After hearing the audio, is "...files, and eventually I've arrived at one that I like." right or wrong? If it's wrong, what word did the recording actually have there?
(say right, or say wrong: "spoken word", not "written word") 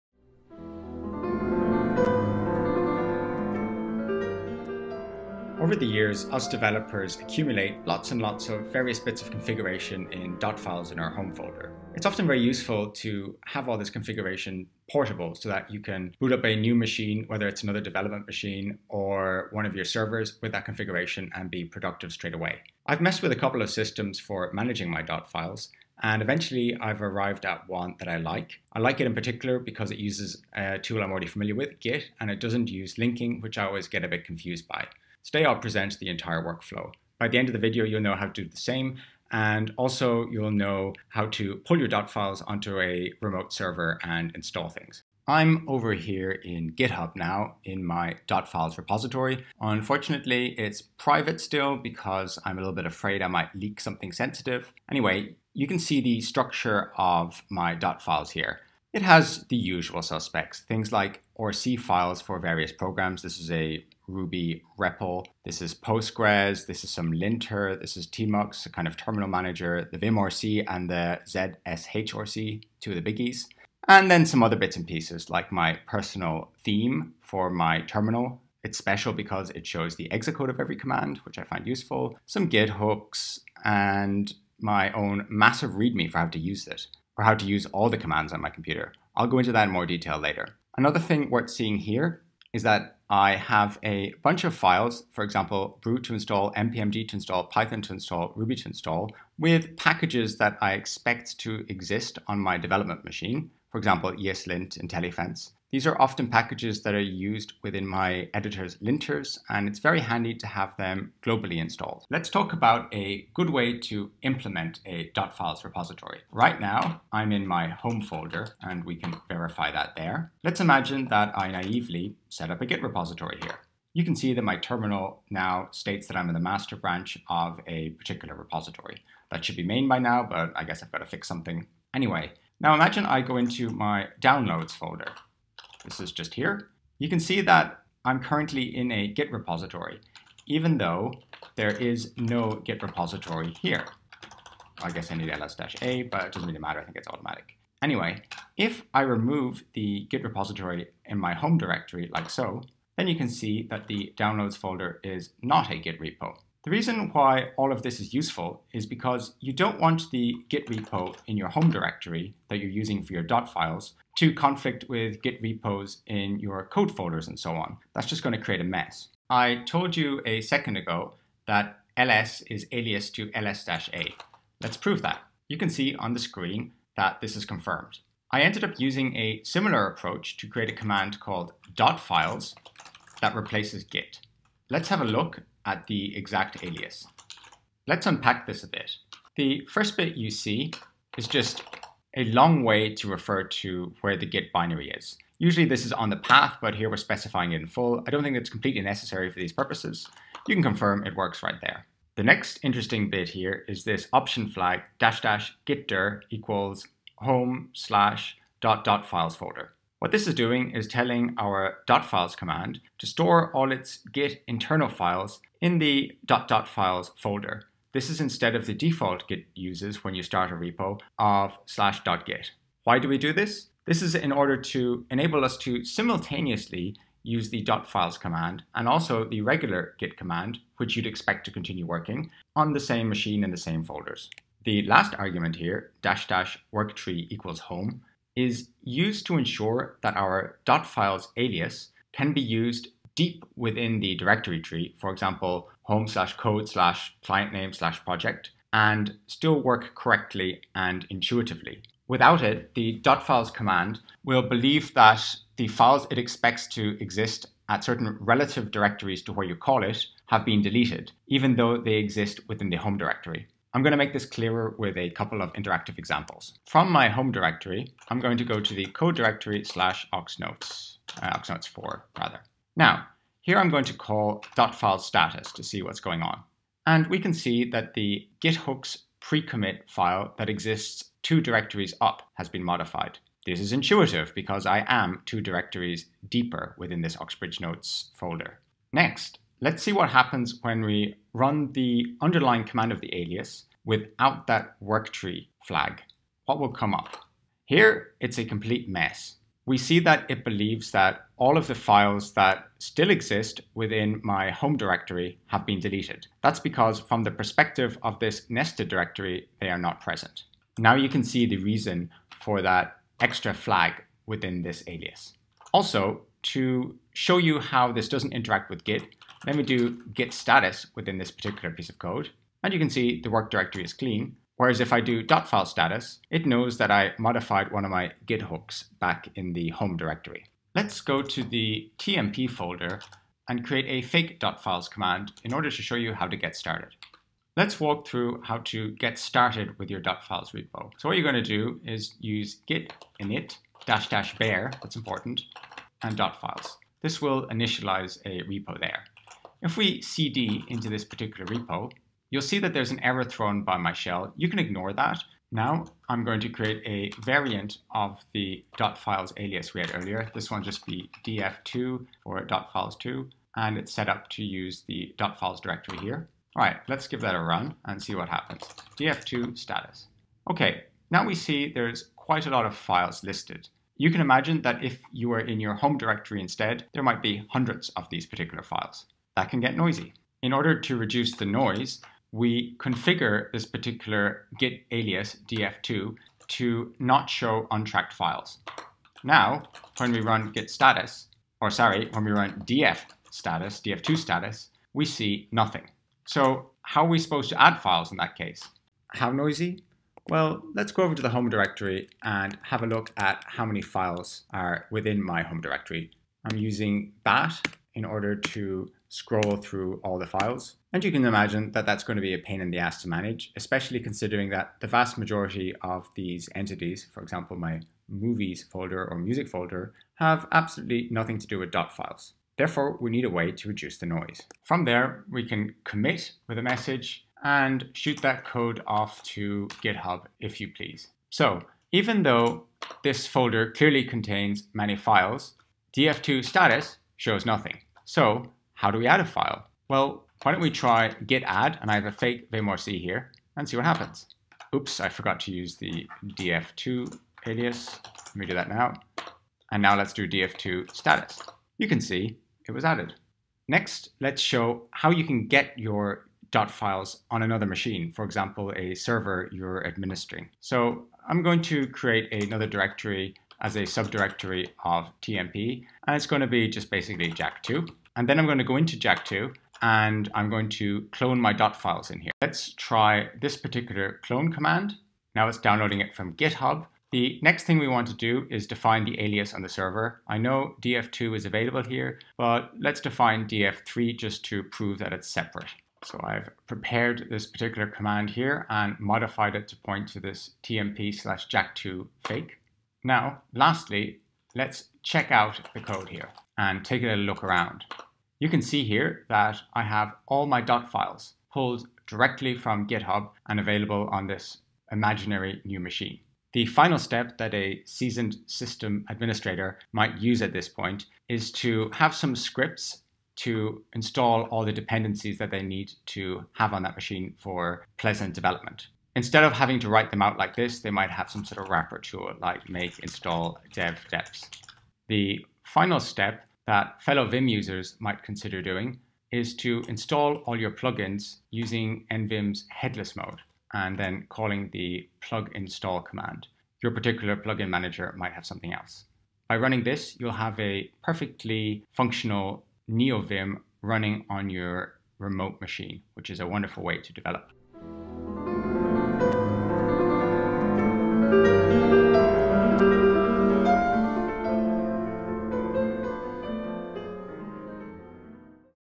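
right.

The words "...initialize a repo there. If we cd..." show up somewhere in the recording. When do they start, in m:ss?
5:47.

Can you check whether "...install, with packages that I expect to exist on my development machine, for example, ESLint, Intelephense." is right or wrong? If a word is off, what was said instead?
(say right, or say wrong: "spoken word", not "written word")
right.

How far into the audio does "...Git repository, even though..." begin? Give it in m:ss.
2:19.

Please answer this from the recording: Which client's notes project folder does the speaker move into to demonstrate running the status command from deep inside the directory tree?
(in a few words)
Oxbridge Notes.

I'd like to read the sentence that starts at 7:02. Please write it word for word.
Therefore, we need a way to reduce the noise.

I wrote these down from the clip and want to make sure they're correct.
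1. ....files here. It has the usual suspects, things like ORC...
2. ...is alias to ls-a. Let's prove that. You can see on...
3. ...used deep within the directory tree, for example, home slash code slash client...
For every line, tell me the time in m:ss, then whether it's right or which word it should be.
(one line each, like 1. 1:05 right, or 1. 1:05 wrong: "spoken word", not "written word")
1. 0:58 right
2. 2:52 right
3. 4:02 right.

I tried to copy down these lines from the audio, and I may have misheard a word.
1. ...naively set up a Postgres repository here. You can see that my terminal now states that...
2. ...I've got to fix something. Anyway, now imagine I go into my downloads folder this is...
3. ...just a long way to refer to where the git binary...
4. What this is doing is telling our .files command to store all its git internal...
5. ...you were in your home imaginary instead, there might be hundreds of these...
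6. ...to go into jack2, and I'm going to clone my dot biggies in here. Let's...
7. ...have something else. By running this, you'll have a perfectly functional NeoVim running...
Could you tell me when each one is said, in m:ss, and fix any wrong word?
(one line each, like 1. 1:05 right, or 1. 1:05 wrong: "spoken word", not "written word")
1. 2:01 wrong: "Git", not "Postgres"
2. 2:10 right
3. 3:11 right
4. 3:30 right
5. 6:15 wrong: "directory", not "imaginary"
6. 7:48 wrong: "files", not "biggies"
7. 8:58 right.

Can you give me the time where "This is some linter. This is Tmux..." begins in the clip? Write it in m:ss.
1:06.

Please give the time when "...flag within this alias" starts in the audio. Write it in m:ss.
5:13.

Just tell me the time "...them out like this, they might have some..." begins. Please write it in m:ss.
8:40.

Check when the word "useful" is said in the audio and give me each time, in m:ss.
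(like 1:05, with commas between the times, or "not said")
0:12, 1:21, 2:38.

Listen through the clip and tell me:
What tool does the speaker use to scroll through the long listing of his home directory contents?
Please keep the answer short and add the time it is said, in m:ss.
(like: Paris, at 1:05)
bat, at 6:47.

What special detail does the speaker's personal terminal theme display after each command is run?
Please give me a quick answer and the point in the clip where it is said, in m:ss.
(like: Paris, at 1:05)
exit code, at 1:20.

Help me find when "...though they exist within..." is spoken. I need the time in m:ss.
4:21.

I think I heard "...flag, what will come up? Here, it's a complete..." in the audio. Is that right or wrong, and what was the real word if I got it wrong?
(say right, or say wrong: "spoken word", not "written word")
right.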